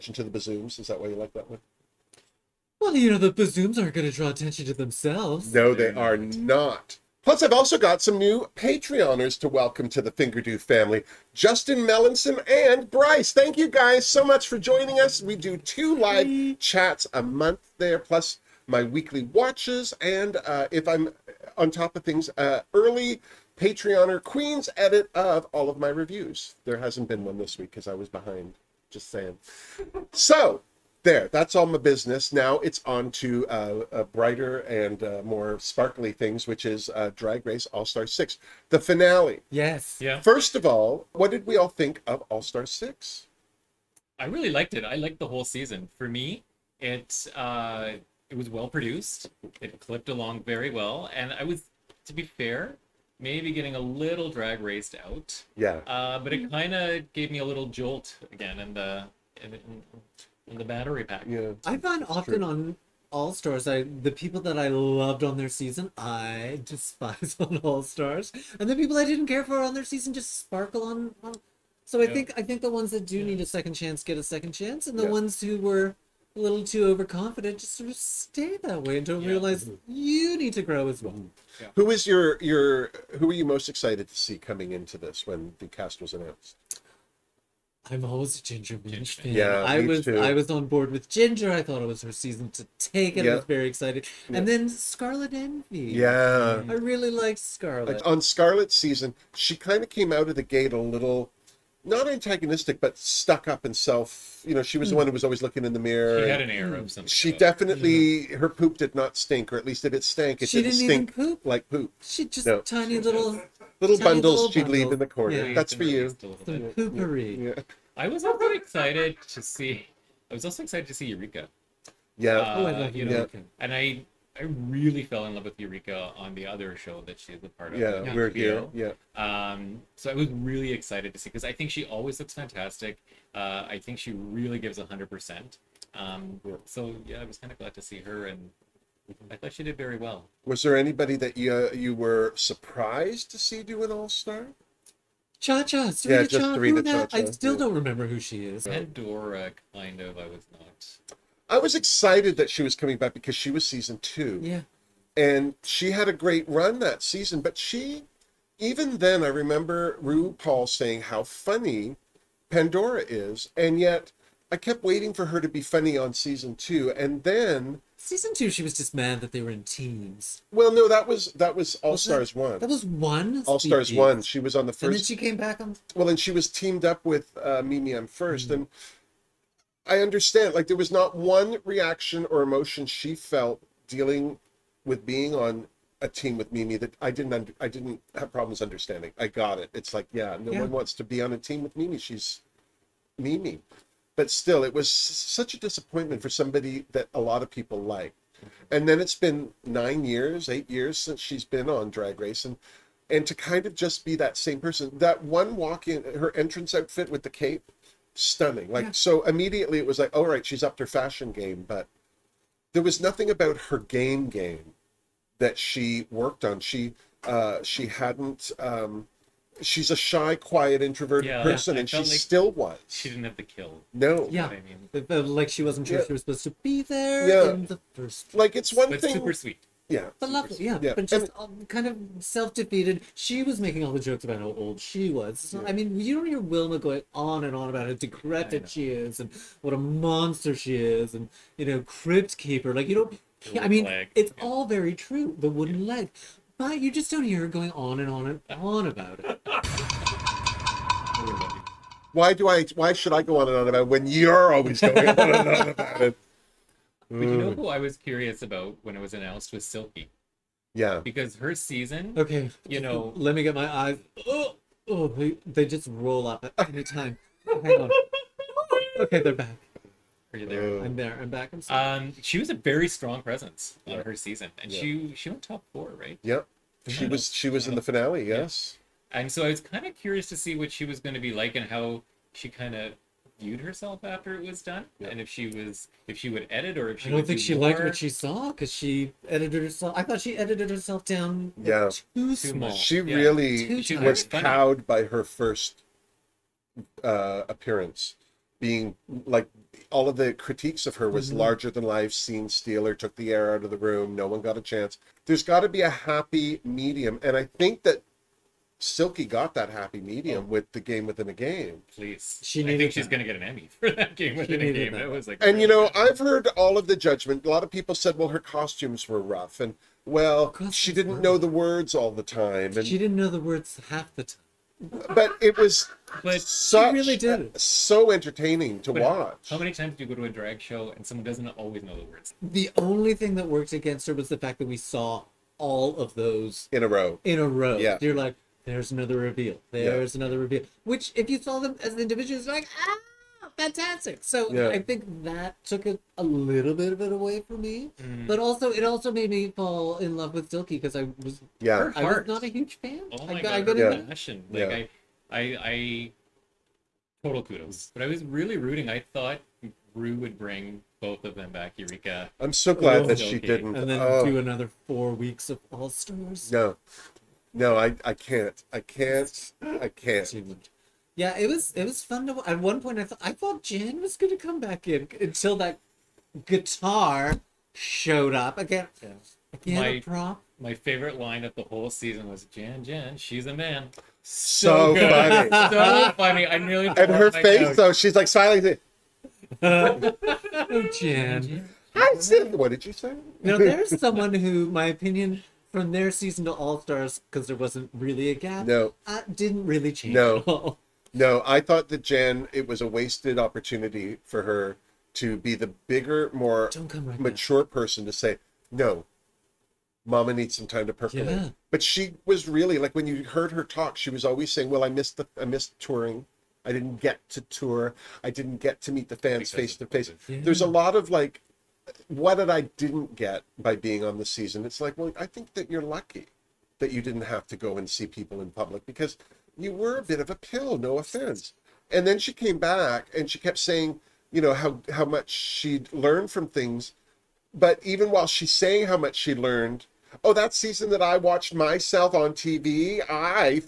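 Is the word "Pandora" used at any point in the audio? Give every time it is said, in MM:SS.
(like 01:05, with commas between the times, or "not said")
02:28, 02:42.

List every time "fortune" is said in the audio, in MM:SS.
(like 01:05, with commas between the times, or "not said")
not said.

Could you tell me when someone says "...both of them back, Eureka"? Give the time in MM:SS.
06:01.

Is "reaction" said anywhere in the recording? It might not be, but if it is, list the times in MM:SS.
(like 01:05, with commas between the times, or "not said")
03:01.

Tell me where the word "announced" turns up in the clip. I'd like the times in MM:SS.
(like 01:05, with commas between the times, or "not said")
01:26, 04:19.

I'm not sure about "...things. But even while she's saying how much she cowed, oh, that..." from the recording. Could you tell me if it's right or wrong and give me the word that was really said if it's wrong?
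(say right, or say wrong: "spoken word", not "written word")
wrong: "learned", not "cowed".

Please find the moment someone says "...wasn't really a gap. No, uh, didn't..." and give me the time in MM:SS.
06:37.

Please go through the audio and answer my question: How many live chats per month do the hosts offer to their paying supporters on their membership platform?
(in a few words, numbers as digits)
2.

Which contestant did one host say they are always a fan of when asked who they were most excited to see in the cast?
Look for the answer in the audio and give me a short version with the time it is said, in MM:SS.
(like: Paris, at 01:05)
Ginger Minj, at 01:28.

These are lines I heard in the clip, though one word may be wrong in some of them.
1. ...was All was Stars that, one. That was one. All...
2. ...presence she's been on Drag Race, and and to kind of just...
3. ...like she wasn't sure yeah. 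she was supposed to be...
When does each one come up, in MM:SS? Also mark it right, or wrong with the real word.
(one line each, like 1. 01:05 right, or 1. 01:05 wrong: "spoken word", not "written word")
1. 02:51 right
2. 03:20 wrong: "since", not "presence"
3. 03:45 right.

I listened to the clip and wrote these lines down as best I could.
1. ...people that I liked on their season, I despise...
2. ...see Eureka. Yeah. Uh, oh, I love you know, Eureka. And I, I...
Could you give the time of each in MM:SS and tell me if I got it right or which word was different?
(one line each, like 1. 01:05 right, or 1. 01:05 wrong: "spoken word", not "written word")
1. 01:04 wrong: "loved", not "liked"
2. 02:00 right.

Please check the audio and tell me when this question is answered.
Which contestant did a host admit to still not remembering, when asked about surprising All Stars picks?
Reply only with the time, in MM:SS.
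02:26.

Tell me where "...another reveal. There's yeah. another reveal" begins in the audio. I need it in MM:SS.
05:38.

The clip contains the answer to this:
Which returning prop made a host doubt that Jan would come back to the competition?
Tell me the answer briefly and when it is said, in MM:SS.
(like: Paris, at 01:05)
guitar, at 06:16.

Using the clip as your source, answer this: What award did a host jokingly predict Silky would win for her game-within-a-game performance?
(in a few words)
Emmy.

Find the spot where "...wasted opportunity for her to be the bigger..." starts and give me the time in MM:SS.
06:42.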